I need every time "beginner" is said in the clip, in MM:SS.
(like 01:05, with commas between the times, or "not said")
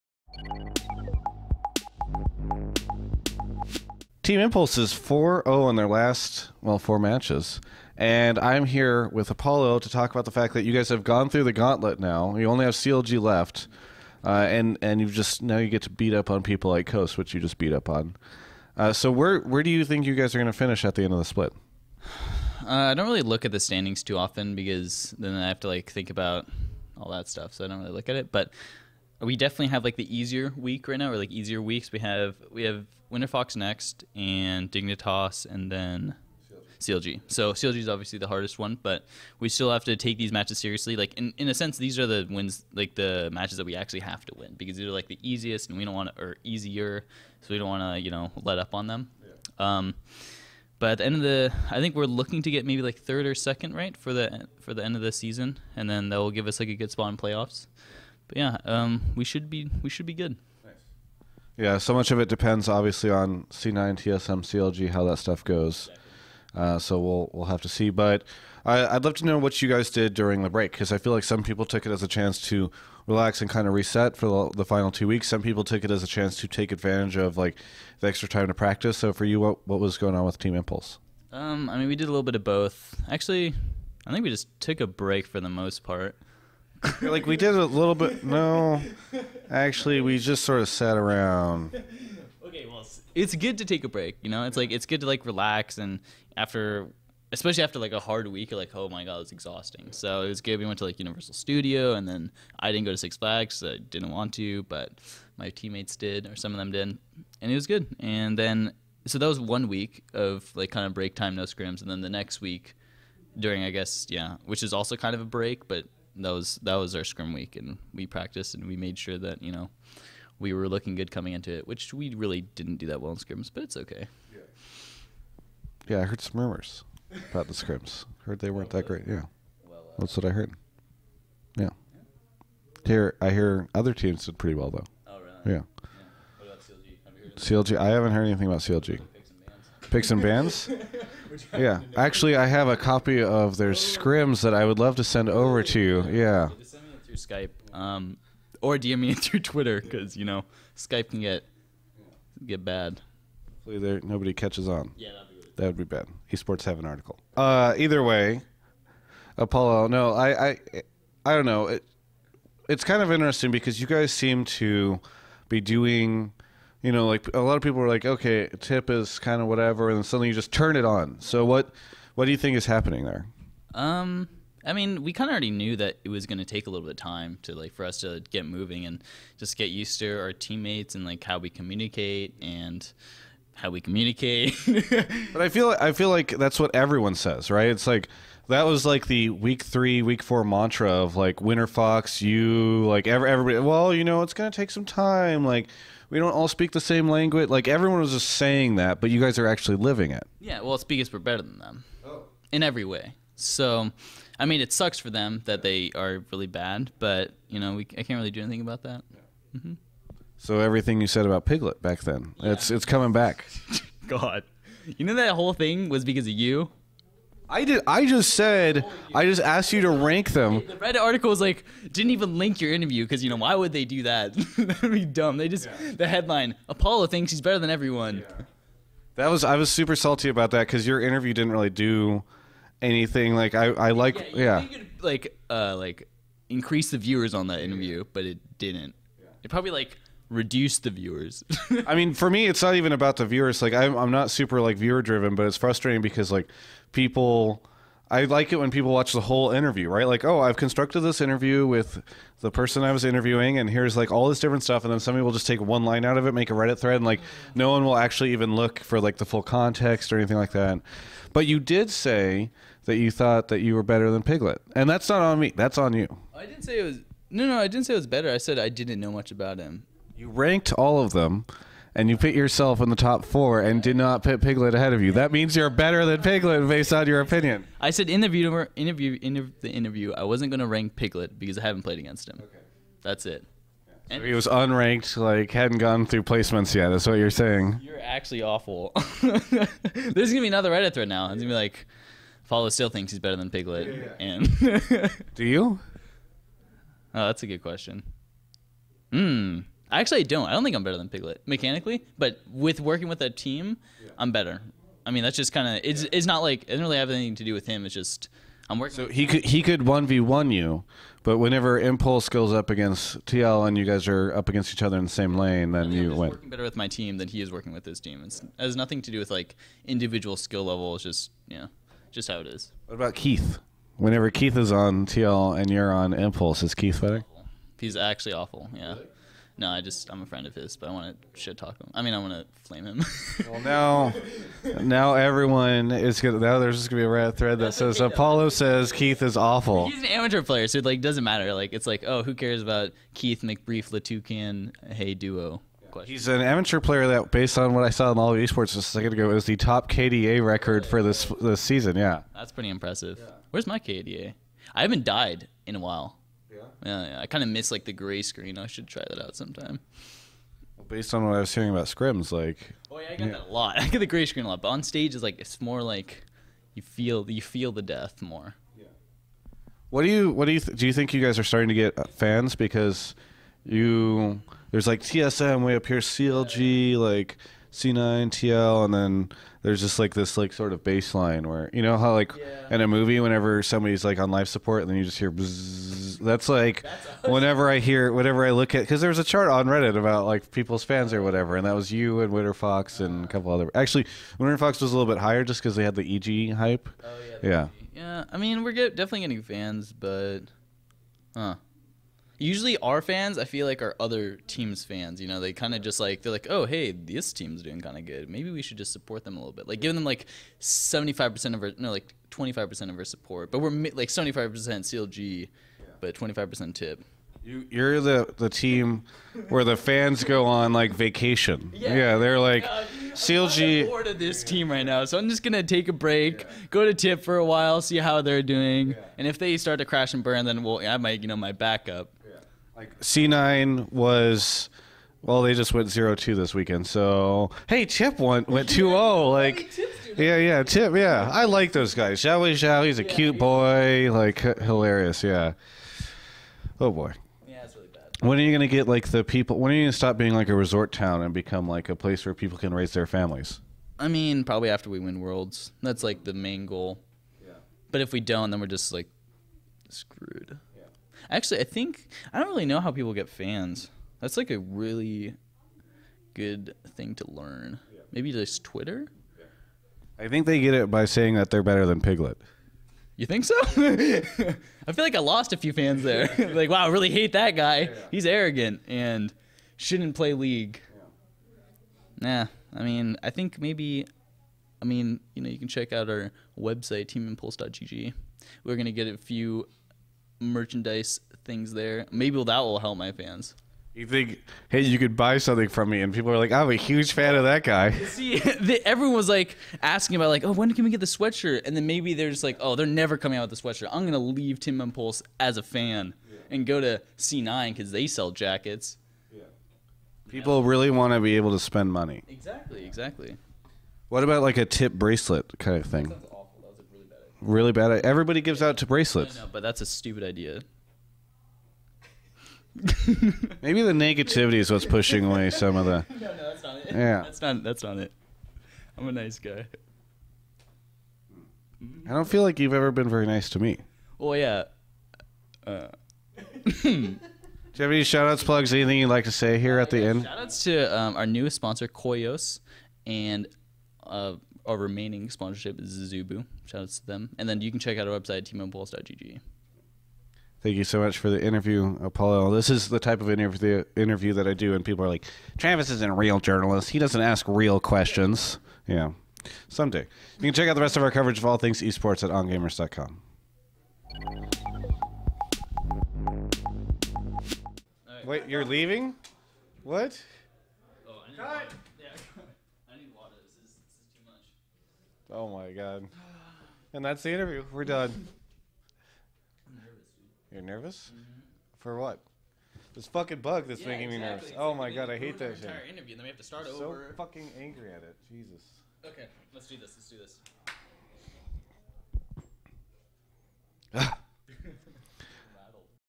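not said.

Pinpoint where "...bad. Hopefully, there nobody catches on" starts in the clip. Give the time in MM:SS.
02:32.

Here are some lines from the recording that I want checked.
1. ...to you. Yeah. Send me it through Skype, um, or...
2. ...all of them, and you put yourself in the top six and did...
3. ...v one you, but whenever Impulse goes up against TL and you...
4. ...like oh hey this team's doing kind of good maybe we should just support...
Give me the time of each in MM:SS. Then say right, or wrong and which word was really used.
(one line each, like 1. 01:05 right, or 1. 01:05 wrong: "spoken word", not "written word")
1. 02:25 right
2. 04:30 wrong: "four", not "six"
3. 05:10 right
4. 06:46 right.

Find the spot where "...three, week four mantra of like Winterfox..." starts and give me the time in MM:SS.
03:09.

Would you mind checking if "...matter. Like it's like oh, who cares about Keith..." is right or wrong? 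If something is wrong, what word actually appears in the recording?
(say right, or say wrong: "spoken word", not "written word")
right.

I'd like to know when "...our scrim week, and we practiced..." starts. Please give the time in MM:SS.
01:56.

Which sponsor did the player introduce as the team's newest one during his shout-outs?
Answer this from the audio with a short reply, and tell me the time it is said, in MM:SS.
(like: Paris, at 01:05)
Koyos, at 09:01.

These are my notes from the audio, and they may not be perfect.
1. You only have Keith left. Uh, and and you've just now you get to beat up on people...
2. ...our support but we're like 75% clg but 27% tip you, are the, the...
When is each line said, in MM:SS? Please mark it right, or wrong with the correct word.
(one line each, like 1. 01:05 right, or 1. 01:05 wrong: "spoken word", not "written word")
1. 00:12 wrong: "CLG", not "Keith"
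2. 06:52 wrong: "25", not "27".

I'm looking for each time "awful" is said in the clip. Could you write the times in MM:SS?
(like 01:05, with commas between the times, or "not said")
04:48, 05:28, 05:39.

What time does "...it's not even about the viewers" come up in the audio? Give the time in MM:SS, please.
04:02.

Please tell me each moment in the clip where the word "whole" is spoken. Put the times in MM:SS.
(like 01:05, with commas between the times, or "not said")
03:35, 04:09.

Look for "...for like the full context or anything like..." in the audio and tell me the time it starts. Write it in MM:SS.
04:18.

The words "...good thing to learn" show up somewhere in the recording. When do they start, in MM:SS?
07:46.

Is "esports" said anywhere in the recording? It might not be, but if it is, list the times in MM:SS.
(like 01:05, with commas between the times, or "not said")
02:36, 05:48, 09:21.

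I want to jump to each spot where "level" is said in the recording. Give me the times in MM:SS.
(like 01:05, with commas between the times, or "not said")
05:20.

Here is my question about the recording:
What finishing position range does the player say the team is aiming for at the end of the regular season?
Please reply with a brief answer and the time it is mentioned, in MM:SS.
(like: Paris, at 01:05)
Third or second, at 00:52.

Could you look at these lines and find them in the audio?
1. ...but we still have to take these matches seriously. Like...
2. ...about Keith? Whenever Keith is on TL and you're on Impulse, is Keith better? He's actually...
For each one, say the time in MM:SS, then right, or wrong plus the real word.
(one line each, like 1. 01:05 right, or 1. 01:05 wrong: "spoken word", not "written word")
1. 00:38 right
2. 05:22 right.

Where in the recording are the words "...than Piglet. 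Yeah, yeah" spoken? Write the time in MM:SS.
04:53.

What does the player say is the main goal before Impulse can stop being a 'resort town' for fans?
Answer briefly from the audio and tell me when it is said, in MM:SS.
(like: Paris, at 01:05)
Win Worlds, at 07:34.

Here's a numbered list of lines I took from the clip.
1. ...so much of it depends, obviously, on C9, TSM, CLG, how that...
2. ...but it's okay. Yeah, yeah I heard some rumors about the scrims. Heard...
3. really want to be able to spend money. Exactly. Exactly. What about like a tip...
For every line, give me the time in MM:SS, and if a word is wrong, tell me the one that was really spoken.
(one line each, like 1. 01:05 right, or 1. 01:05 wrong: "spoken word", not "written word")
1. 01:01 right
2. 02:03 right
3. 08:30 right.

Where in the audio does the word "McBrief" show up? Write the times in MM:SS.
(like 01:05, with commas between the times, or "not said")
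05:43.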